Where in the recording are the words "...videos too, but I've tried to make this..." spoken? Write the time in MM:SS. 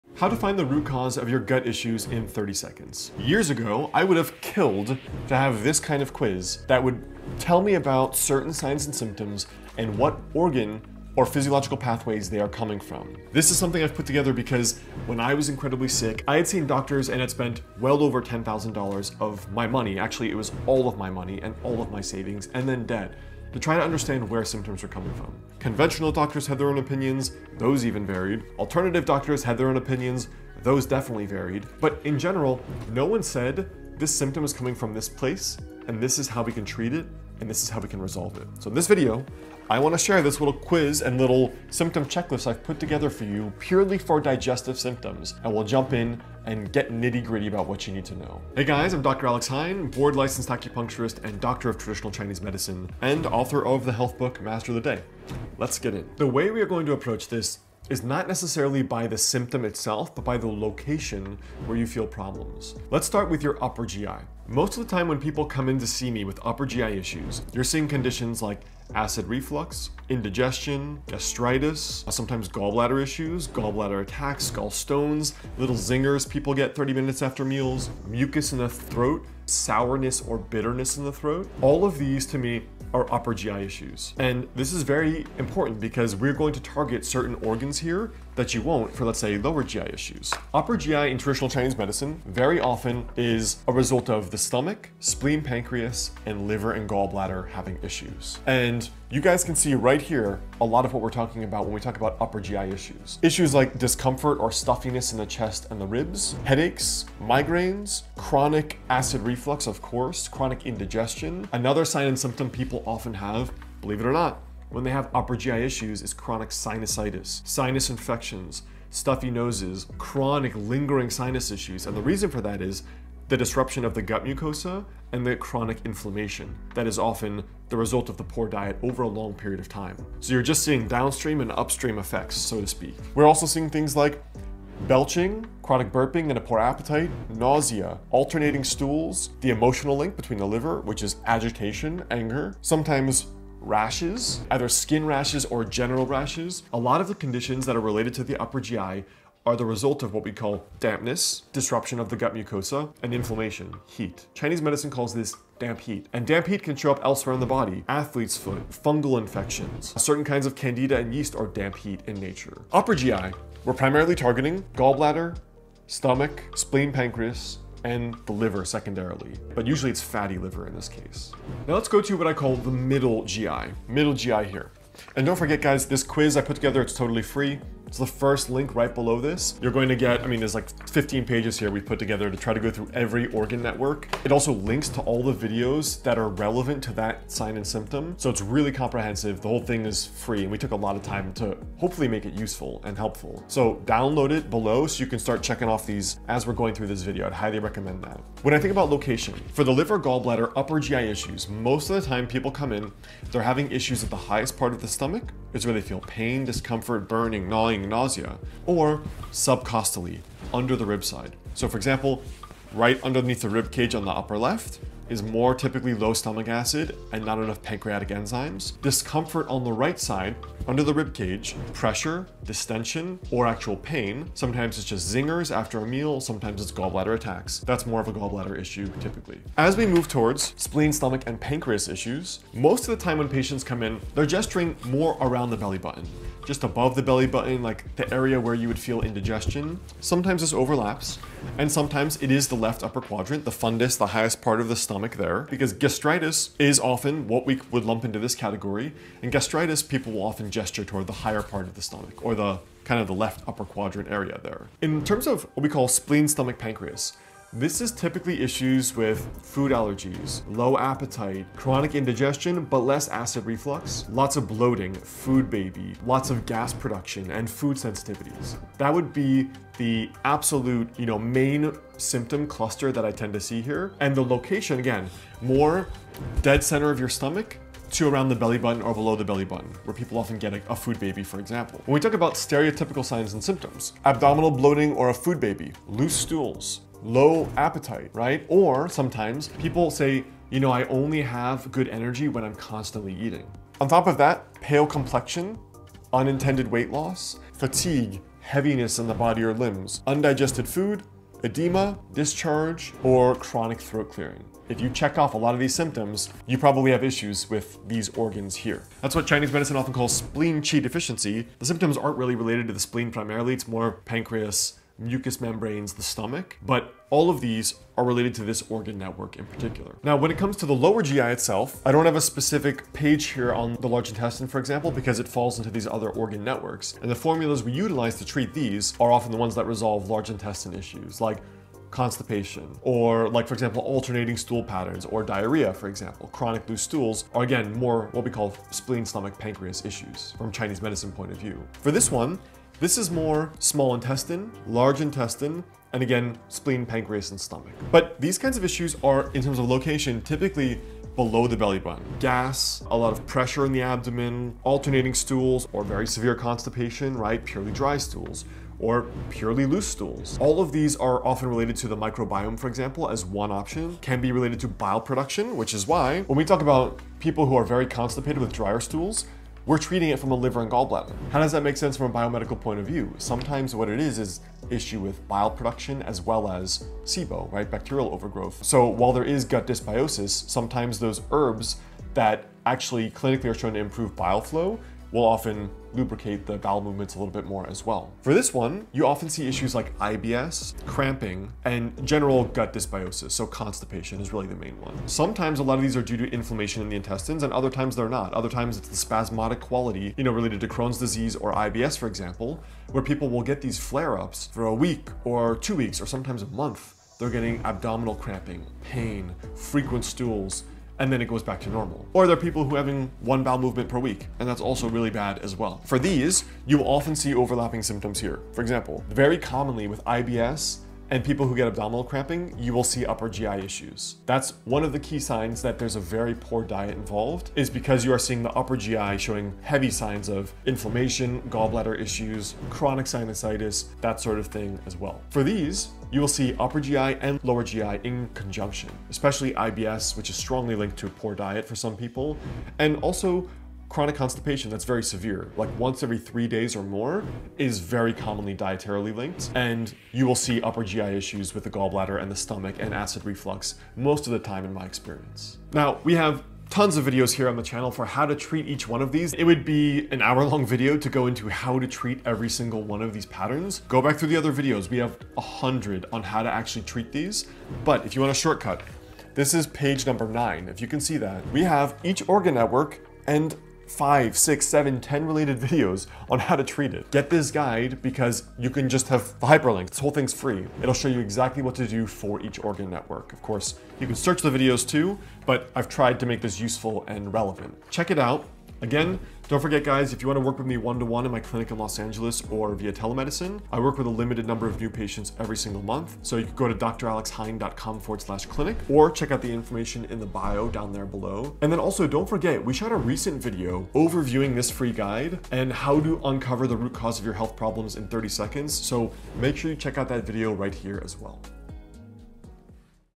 08:04.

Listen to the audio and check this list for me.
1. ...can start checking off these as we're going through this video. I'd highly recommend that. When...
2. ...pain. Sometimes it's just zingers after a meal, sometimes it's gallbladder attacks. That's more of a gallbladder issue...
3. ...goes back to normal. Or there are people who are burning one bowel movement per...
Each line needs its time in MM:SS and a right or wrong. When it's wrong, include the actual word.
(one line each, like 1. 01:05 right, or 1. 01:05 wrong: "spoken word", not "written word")
1. 03:15 right
2. 03:43 right
3. 06:51 wrong: "having", not "burning".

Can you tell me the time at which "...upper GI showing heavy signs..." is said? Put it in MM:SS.
07:08.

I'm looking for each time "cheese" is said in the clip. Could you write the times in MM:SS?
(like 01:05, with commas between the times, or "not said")
not said.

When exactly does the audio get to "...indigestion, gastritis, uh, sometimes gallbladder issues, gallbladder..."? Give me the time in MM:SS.
01:10.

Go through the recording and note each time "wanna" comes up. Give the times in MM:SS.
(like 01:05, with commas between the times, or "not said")
00:39, 08:10.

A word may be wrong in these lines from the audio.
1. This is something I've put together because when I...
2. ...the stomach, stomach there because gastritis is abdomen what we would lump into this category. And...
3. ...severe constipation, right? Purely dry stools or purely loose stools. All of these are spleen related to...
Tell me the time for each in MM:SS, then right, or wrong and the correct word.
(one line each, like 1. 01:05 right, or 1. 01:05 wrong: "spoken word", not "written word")
1. 00:13 right
2. 04:04 wrong: "often", not "abdomen"
3. 05:56 wrong: "often", not "spleen".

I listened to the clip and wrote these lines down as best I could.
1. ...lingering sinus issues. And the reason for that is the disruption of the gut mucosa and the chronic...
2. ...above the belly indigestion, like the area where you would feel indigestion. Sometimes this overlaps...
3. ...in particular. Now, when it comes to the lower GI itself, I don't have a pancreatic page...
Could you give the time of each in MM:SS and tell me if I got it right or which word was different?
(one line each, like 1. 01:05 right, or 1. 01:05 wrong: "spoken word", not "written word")
1. 02:00 right
2. 03:56 wrong: "button", not "indigestion"
3. 05:19 wrong: "specific", not "pancreatic".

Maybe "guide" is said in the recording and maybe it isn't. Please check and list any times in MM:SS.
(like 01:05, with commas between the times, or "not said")
07:57, 08:24.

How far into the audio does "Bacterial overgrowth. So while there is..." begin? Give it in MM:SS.
06:17.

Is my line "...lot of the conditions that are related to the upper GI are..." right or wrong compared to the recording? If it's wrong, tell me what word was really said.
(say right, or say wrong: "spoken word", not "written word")
right.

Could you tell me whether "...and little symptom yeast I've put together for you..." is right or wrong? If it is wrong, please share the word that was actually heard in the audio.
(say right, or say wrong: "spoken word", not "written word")
wrong: "checklist", not "yeast".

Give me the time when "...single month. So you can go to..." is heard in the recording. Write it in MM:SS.
08:15.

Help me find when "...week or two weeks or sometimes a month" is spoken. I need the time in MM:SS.
06:44.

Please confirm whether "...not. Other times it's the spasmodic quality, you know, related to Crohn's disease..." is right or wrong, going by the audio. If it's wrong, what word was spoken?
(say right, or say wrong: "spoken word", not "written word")
right.